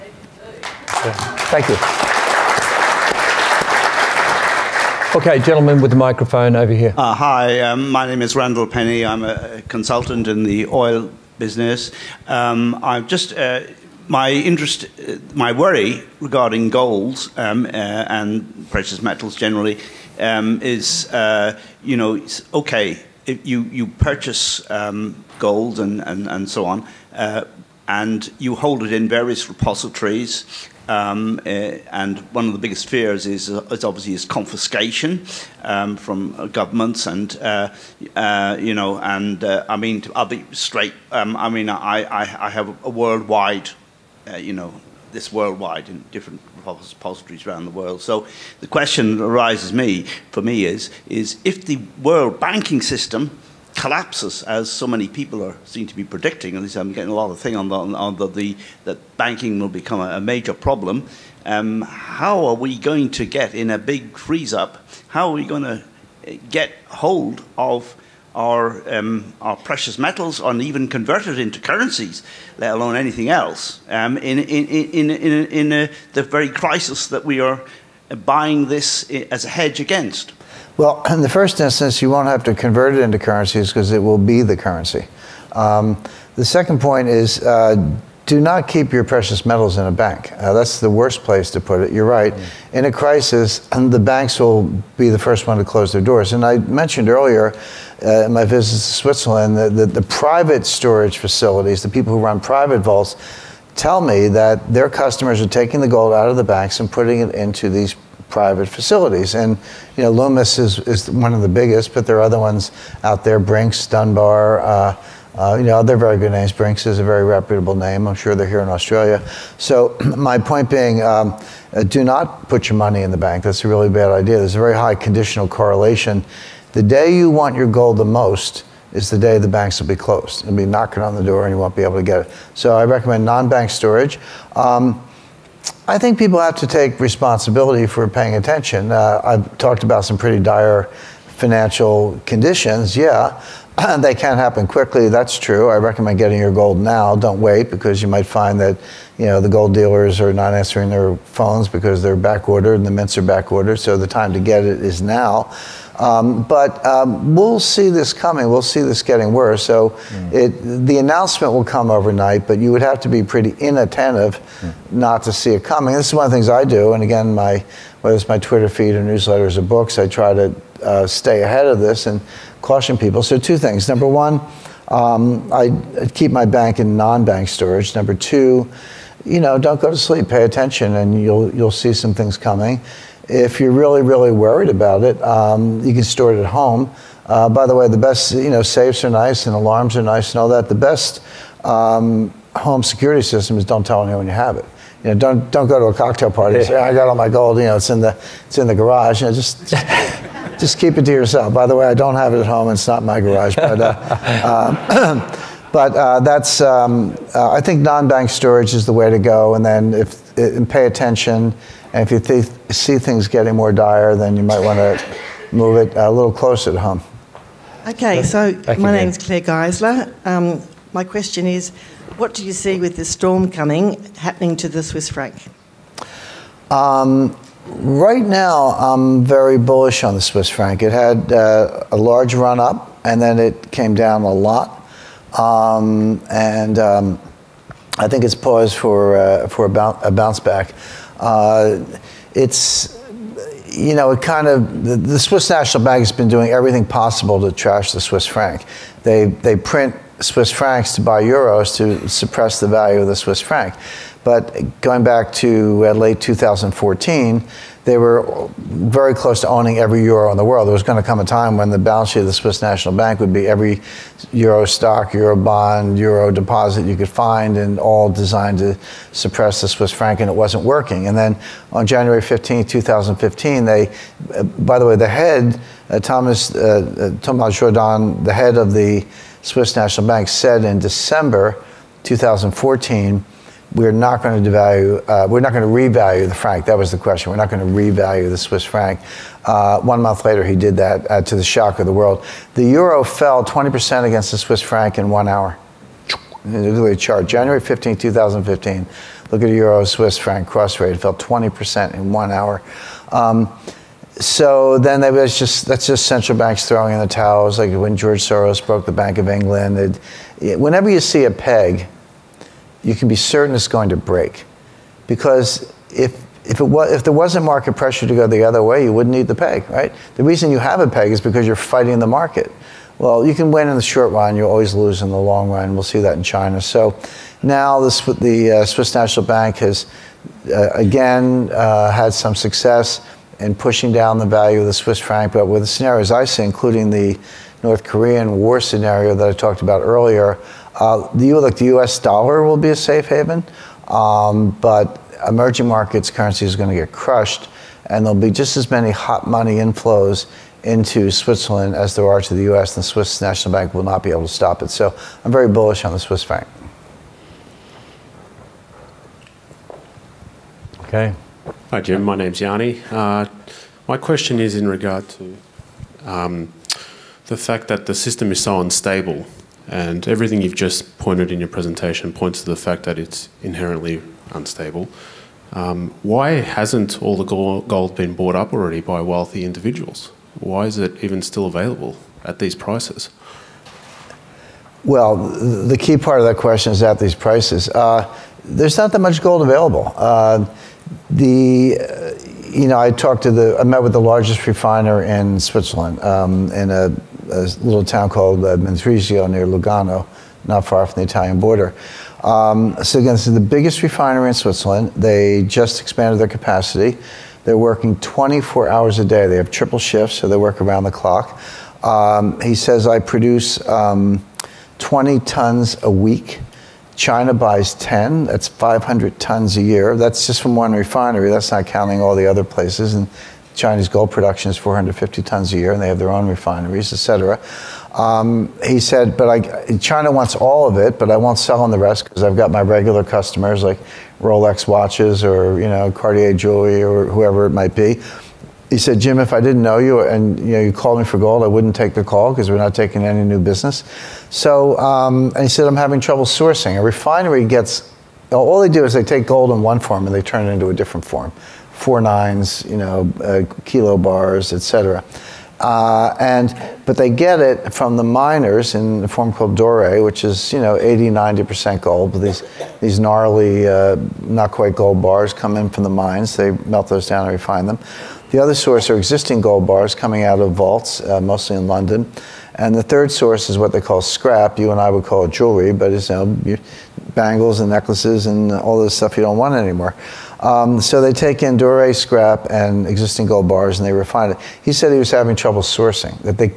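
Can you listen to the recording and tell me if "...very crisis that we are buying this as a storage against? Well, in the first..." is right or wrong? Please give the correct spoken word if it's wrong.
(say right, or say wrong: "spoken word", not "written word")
wrong: "hedge", not "storage".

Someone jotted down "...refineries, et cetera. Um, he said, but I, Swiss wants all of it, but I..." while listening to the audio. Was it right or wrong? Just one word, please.
wrong.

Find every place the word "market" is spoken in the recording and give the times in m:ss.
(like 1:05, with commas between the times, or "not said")
5:17, 5:22, 5:45.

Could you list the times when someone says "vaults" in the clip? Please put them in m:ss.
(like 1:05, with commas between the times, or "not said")
1:42, 7:50.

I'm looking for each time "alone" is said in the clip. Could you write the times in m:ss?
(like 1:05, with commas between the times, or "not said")
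1:12.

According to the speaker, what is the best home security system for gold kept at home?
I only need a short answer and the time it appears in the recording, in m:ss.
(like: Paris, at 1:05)
Don't tell anyone, at 3:13.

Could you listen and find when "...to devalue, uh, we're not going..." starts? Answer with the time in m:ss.
4:44.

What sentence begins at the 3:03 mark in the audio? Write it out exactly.
If you're really, really worried about it, um, you can store it at home.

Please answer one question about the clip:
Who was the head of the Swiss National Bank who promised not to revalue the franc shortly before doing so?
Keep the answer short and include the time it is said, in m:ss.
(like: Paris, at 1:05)
Thomas Jordan, at 4:37.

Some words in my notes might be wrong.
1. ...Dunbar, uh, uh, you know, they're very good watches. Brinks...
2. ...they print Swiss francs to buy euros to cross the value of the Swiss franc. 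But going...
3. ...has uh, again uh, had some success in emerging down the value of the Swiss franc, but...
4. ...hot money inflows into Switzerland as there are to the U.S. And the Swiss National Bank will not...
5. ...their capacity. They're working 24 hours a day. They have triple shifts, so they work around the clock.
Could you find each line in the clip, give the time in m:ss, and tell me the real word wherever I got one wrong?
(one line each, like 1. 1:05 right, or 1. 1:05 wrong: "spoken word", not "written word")
1. 1:53 wrong: "names", not "watches"
2. 4:09 wrong: "suppress", not "cross"
3. 5:29 wrong: "pushing", not "emerging"
4. 5:48 right
5. 6:46 right.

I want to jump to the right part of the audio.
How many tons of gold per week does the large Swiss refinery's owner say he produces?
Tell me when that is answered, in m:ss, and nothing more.
6:54.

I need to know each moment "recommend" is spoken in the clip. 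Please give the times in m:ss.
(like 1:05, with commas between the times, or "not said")
2:12, 2:25.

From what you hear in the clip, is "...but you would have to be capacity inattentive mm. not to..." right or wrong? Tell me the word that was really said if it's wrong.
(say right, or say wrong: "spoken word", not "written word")
wrong: "pretty", not "capacity".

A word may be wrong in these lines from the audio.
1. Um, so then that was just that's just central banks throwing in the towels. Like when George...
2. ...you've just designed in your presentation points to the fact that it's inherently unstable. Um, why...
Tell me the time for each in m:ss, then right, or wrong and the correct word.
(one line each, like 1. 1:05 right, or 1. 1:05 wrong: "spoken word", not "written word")
1. 5:03 right
2. 6:10 wrong: "pointed", not "designed".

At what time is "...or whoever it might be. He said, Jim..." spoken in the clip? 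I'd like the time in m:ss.
7:16.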